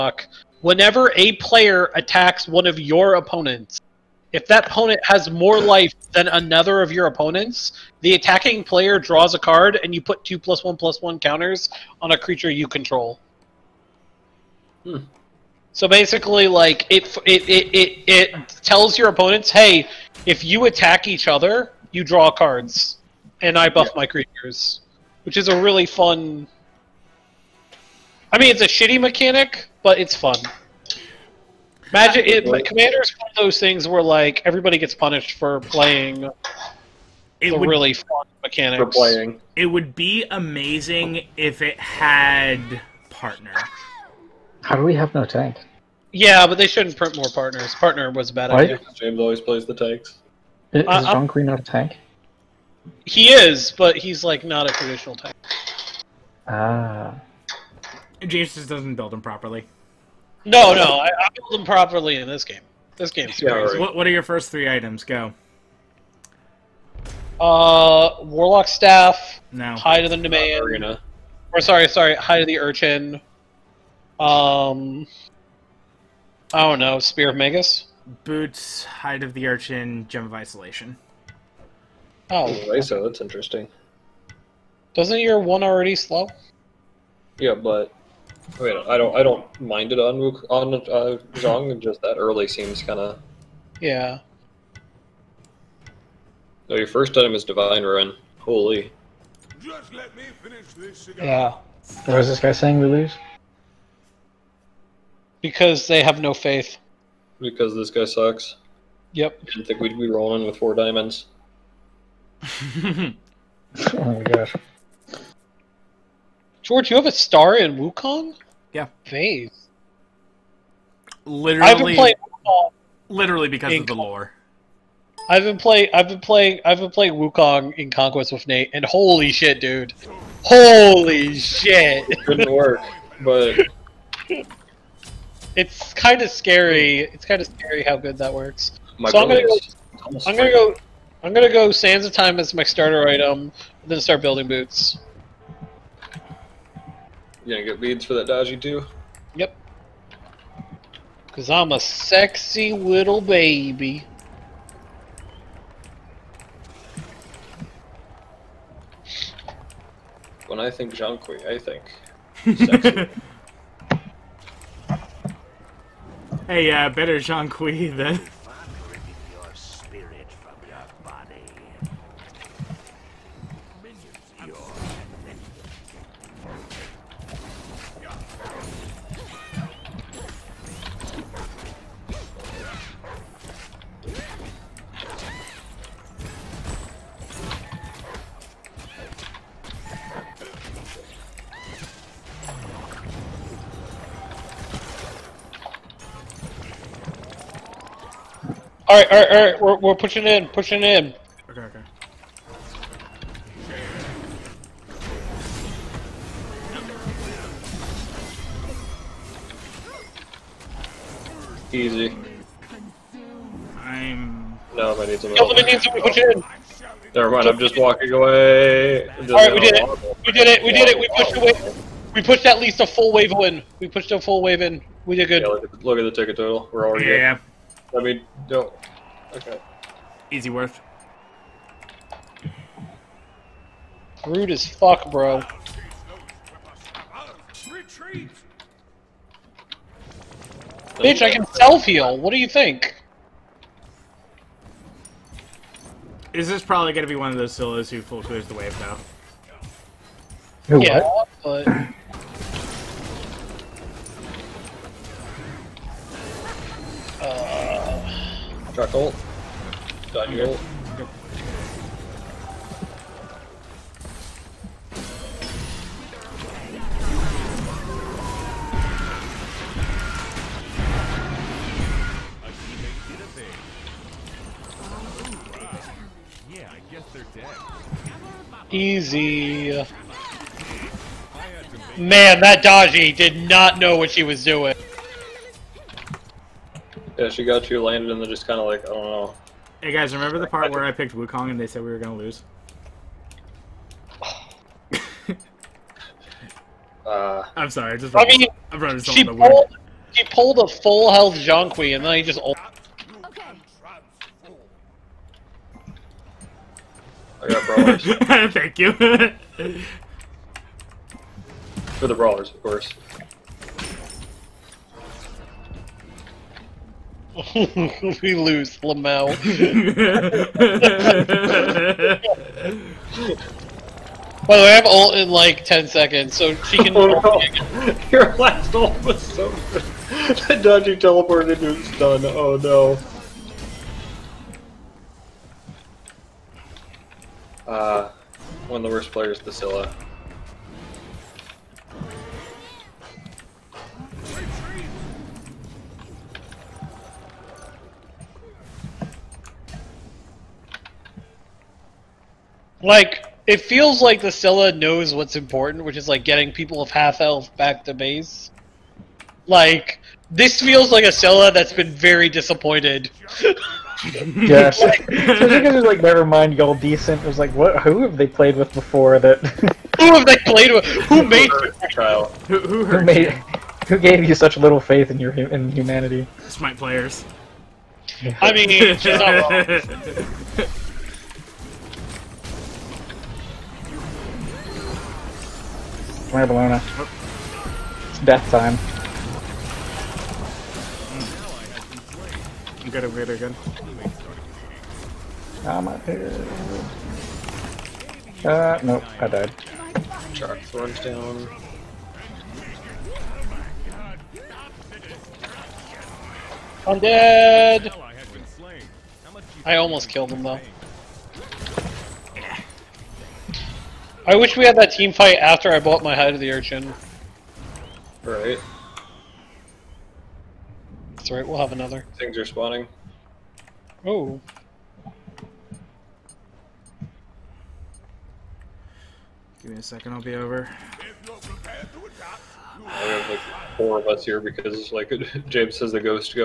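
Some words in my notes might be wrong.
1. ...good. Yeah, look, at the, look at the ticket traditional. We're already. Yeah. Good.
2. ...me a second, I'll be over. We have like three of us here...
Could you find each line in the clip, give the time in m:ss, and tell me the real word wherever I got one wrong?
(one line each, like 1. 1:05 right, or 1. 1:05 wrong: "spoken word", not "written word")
1. 3:45 wrong: "total", not "traditional"
2. 7:09 wrong: "four", not "three".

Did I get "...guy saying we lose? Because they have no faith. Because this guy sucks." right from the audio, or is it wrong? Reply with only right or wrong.
right.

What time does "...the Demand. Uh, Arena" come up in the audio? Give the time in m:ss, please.
1:10.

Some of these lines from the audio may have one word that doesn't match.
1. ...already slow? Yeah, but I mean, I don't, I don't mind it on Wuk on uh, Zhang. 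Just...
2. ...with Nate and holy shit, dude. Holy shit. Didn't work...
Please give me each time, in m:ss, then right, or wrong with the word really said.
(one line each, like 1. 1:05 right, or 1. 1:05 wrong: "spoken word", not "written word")
1. 1:25 right
2. 2:08 right.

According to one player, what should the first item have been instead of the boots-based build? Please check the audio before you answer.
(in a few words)
Divine Ruin.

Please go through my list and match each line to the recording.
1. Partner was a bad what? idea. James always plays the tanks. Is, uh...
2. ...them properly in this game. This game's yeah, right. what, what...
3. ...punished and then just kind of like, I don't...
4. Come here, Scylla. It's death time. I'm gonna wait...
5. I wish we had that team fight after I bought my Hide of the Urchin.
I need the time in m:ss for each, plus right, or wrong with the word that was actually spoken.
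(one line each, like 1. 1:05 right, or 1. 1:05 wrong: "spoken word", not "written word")
1. 0:47 right
2. 1:01 right
3. 4:47 wrong: "landed", not "punished"
4. 6:26 wrong: "Bologna", not "Scylla"
5. 6:54 right.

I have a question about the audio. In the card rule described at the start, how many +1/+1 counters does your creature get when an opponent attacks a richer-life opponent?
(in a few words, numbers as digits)
2.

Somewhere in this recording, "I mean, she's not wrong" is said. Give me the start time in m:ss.
6:18.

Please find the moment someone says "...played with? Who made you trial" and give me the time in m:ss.
6:10.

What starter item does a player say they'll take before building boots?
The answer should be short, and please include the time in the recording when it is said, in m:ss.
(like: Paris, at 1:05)
Sands of Time, at 2:21.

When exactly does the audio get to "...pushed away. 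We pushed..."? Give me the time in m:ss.
3:41.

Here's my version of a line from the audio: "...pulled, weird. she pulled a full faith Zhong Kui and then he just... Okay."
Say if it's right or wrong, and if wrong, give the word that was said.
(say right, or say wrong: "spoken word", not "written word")
wrong: "health", not "faith".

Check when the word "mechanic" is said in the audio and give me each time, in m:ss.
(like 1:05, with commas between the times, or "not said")
0:28, 0:38.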